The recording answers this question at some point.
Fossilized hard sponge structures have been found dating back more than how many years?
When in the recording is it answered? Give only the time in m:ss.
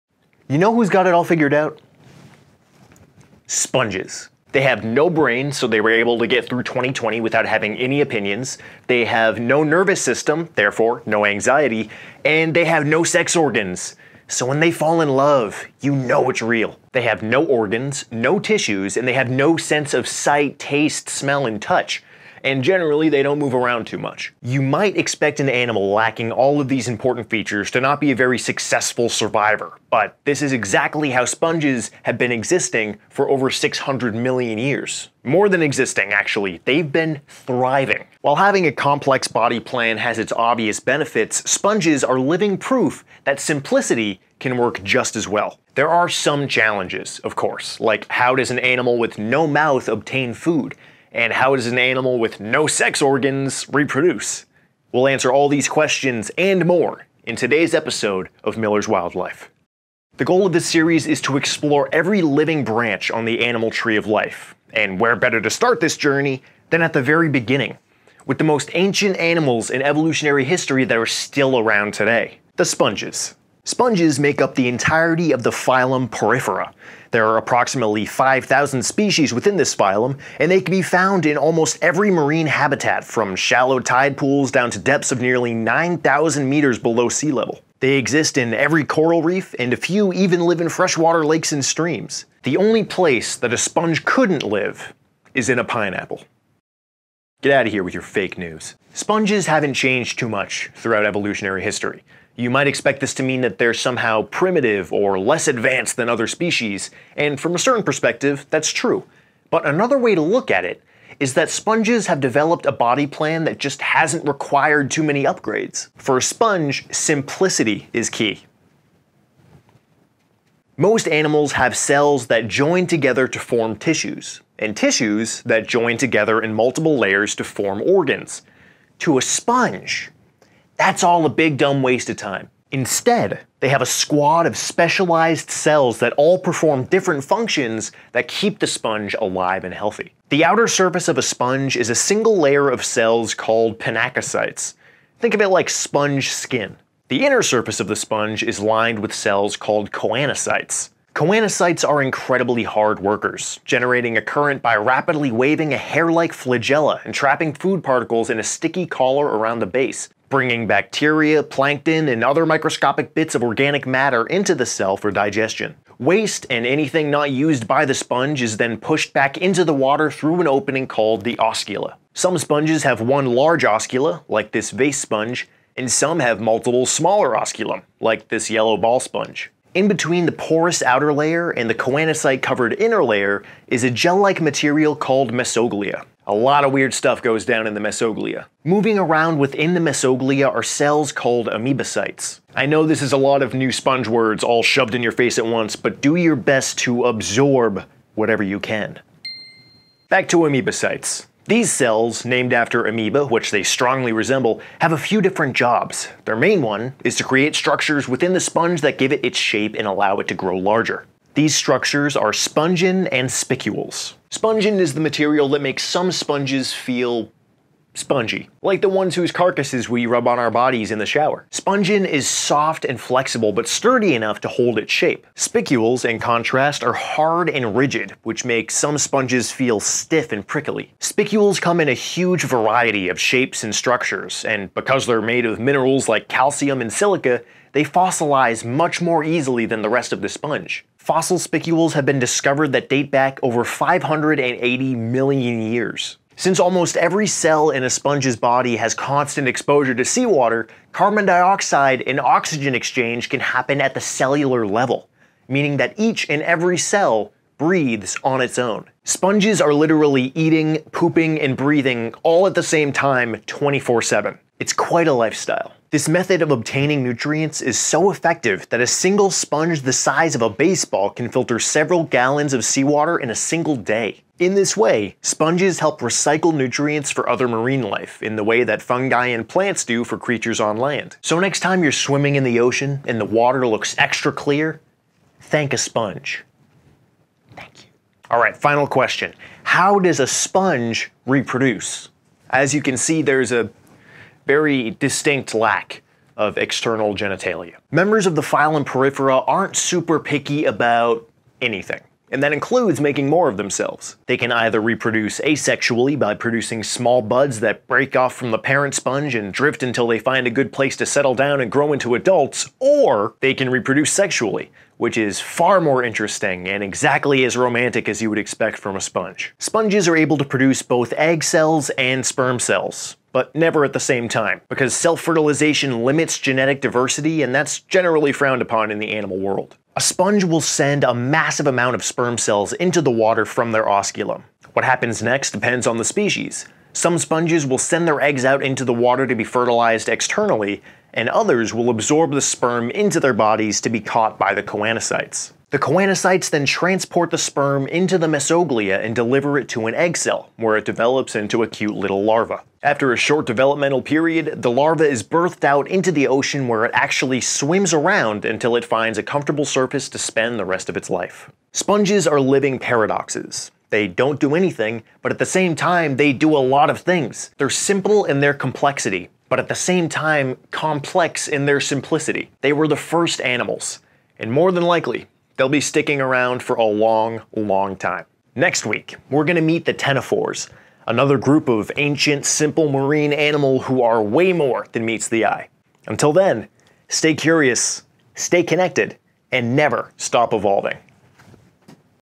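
4:03.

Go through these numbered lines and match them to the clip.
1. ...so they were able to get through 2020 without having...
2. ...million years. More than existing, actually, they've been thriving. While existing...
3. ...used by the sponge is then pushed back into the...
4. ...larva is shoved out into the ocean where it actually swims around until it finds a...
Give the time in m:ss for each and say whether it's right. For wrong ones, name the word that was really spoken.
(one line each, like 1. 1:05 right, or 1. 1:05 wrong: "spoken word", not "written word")
1. 0:05 right
2. 0:34 wrong: "having", not "existing"
3. 2:47 right
4. 5:54 wrong: "birthed", not "shoved".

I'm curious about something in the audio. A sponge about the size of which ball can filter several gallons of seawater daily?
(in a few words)
baseball.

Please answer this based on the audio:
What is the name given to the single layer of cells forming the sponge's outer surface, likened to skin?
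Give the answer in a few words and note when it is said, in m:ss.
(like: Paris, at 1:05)
pinacocytes, at 2:23.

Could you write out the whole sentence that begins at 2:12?
Instead, they have a squad of specialized cells that all perform different functions that keep the sponge alive and healthy.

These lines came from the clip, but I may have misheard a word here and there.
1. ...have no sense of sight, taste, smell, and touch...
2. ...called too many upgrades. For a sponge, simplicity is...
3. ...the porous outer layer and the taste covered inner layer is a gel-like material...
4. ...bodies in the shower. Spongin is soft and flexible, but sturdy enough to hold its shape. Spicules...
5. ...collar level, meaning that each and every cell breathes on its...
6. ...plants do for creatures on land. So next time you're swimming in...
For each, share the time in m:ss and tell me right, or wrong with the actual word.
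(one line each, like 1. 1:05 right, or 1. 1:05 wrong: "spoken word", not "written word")
1. 0:19 right
2. 1:54 wrong: "required", not "called"
3. 3:00 wrong: "choanocyte", not "taste"
4. 3:40 right
5. 4:13 wrong: "cellular", not "collar"
6. 4:39 right.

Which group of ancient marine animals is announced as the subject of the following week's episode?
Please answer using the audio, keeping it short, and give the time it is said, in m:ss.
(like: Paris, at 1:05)
Ctenophores, at 6:19.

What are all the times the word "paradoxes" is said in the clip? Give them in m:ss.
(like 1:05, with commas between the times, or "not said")
6:02.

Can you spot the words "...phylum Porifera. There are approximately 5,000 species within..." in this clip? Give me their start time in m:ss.
1:15.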